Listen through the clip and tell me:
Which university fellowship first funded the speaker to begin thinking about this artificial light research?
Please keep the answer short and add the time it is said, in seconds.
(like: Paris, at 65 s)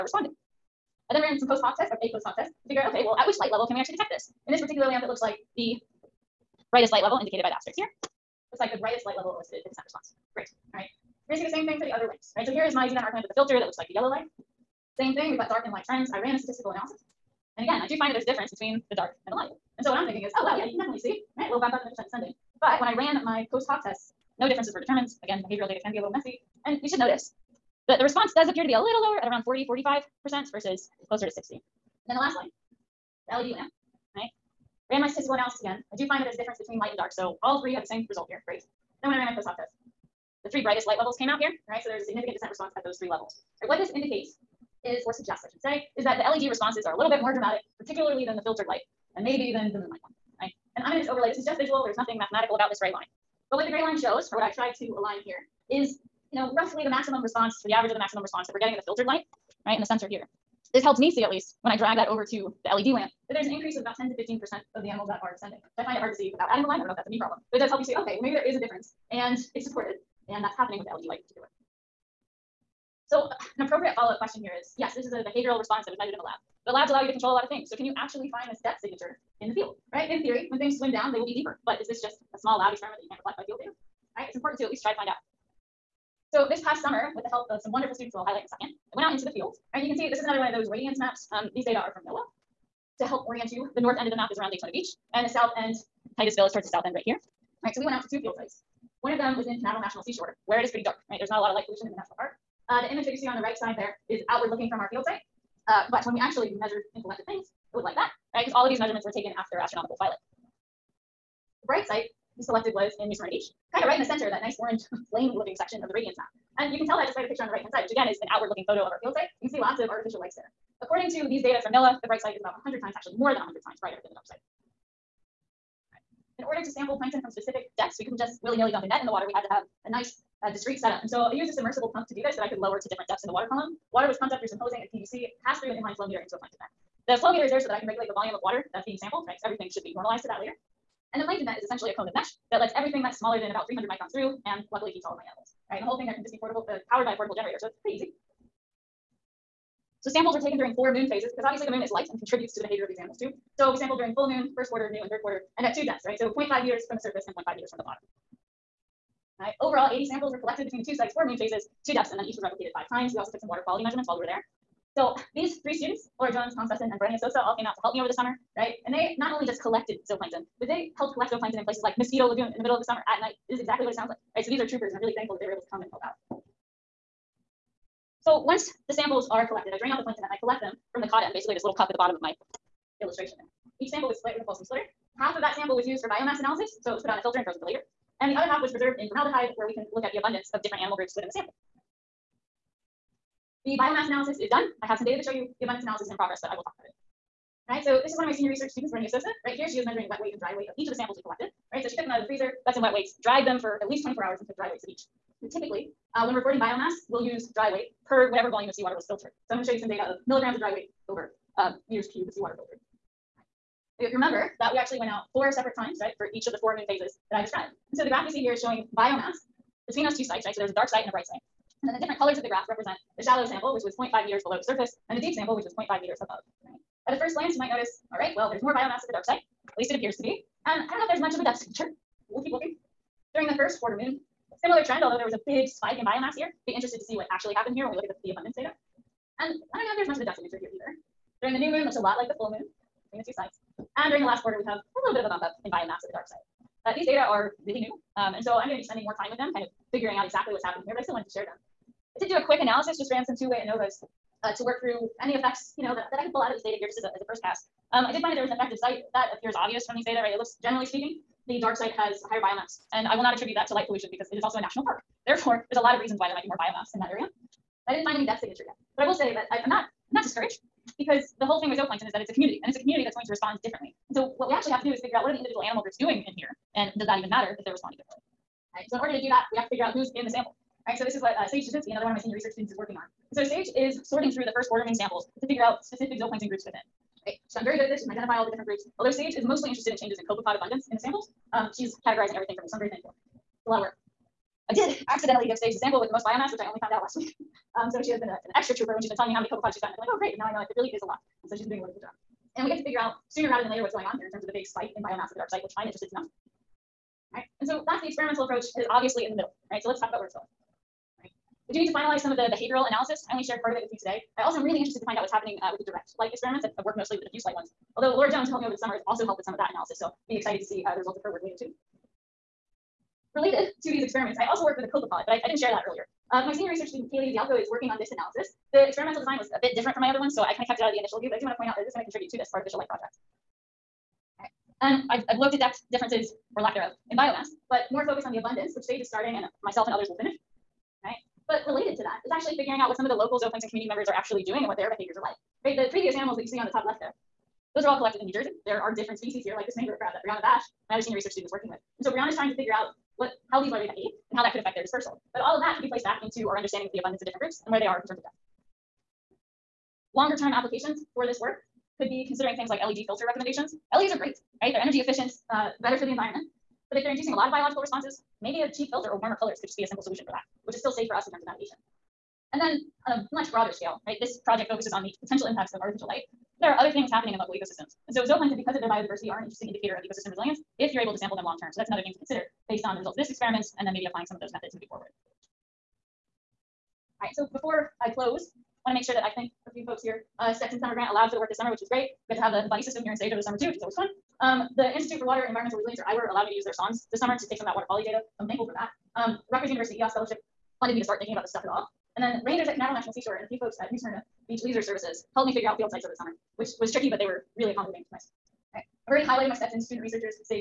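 Rutgers University EOS Fellowship, at 399 s.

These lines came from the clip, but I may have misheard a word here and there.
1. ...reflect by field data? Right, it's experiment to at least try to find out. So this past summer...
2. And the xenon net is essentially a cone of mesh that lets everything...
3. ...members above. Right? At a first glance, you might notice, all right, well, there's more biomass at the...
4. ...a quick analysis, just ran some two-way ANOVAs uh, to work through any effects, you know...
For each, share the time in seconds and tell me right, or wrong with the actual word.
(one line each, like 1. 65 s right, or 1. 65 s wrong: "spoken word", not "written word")
1. 83 s wrong: "important", not "experiment"
2. 141 s wrong: "plankton", not "xenon"
3. 226 s wrong: "meters", not "members"
4. 252 s right.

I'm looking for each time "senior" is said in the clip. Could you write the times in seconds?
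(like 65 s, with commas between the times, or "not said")
198 s, 282 s, 326 s, 351 s.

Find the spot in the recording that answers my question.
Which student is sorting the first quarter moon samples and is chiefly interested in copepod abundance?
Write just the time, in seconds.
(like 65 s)
281 s.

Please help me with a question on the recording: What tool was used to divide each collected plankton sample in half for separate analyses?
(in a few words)
Folsom splitter.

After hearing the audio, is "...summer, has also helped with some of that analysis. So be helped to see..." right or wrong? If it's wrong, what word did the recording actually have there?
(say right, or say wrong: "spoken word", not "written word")
wrong: "excited", not "helped".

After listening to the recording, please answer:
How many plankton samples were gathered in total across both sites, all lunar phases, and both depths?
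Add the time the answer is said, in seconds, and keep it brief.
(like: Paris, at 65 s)
80, at 159 s.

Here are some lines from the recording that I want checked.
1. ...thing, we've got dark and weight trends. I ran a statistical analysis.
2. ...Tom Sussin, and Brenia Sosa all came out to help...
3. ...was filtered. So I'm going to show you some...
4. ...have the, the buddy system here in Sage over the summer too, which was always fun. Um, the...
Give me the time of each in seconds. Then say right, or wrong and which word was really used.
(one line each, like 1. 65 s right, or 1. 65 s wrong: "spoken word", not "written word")
1. 15 s wrong: "light", not "weight"
2. 166 s right
3. 208 s right
4. 392 s right.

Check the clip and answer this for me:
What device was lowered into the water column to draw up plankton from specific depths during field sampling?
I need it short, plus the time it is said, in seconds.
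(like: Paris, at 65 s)
submersible pump, at 131 s.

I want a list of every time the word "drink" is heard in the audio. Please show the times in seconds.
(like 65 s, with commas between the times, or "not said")
not said.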